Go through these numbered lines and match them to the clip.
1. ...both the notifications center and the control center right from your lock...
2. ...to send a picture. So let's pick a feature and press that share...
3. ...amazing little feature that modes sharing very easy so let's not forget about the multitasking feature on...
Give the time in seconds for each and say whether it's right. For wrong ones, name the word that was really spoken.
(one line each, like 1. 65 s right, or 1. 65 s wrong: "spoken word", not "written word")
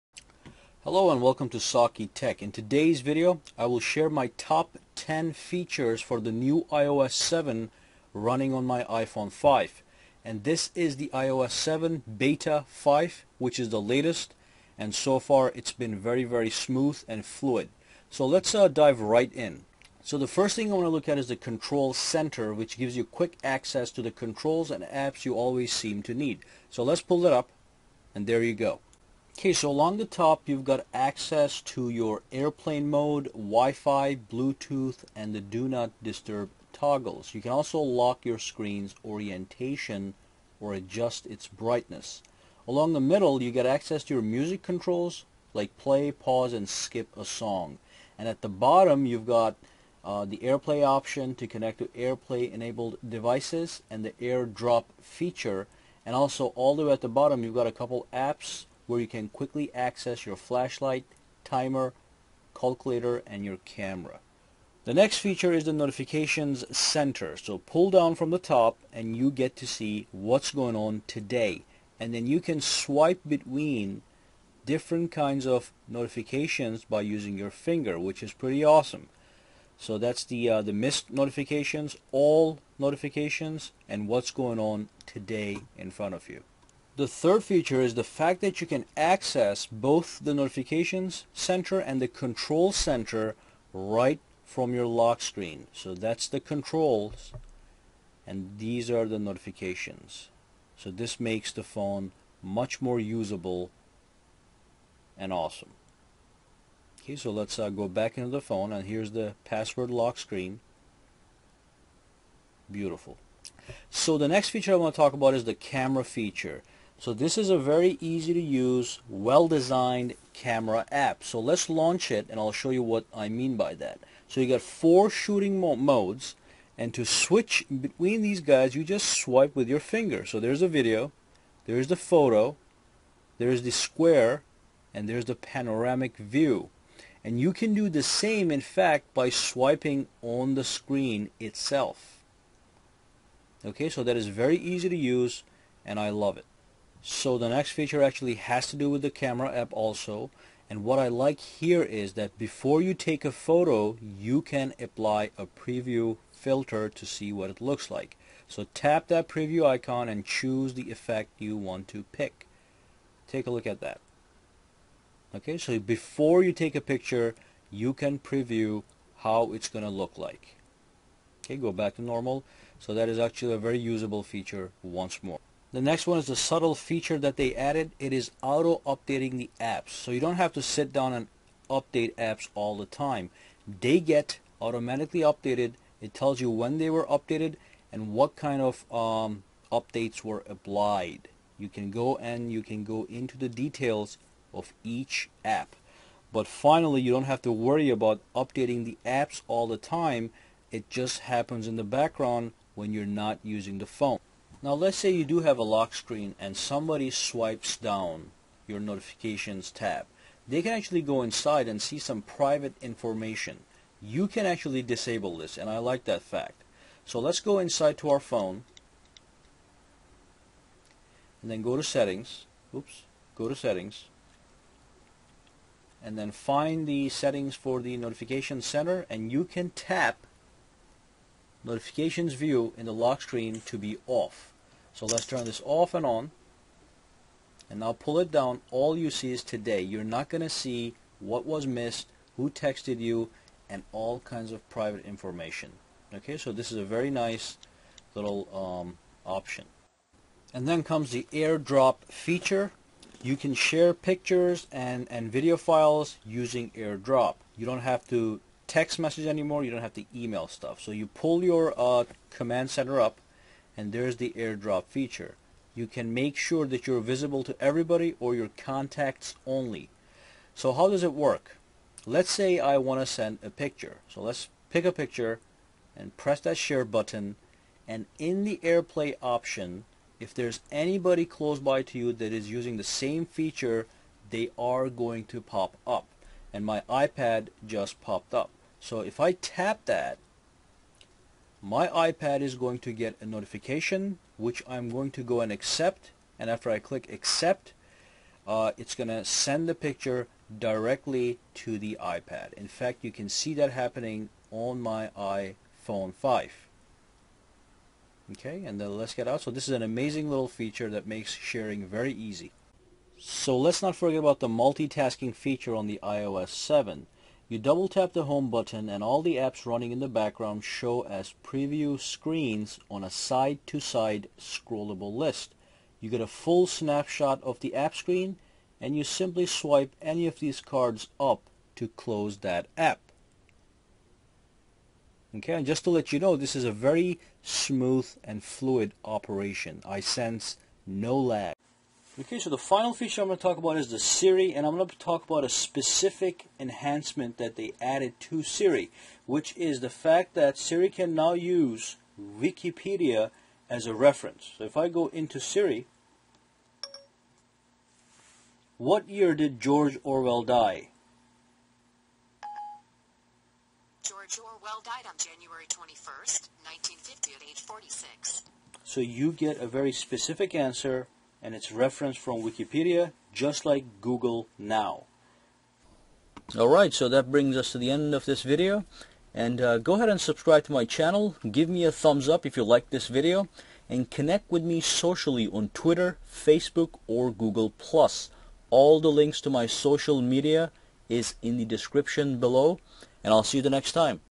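1. 89 s right
2. 273 s wrong: "picture", not "feature"
3. 309 s wrong: "makes", not "modes".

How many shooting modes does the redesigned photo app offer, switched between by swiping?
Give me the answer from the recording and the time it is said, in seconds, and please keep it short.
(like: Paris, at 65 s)
4, at 124 s.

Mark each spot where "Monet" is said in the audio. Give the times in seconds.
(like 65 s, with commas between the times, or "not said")
not said.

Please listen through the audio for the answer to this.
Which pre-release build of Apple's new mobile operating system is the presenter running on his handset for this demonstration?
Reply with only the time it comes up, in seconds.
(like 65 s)
12 s.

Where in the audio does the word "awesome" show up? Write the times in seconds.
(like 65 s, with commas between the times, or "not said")
78 s, 105 s.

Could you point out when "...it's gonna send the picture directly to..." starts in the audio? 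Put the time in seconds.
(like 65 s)
298 s.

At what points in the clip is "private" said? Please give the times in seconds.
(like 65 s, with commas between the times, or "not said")
212 s, 244 s.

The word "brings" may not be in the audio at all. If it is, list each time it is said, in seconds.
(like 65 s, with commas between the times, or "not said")
377 s.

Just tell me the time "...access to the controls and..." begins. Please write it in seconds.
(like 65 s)
23 s.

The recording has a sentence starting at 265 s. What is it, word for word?
You can make sure that you're visible to everybody or your contacts only.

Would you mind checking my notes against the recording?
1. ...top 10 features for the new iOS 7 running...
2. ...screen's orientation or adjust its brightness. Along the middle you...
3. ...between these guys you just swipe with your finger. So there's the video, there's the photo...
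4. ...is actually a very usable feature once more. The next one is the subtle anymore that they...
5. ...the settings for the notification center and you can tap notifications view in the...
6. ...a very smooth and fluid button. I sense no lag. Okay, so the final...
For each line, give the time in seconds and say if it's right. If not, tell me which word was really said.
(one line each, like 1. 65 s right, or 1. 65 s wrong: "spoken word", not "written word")
1. 4 s right
2. 38 s right
3. 127 s right
4. 173 s wrong: "feature", not "anymore"
5. 226 s right
6. 336 s wrong: "operation", not "button".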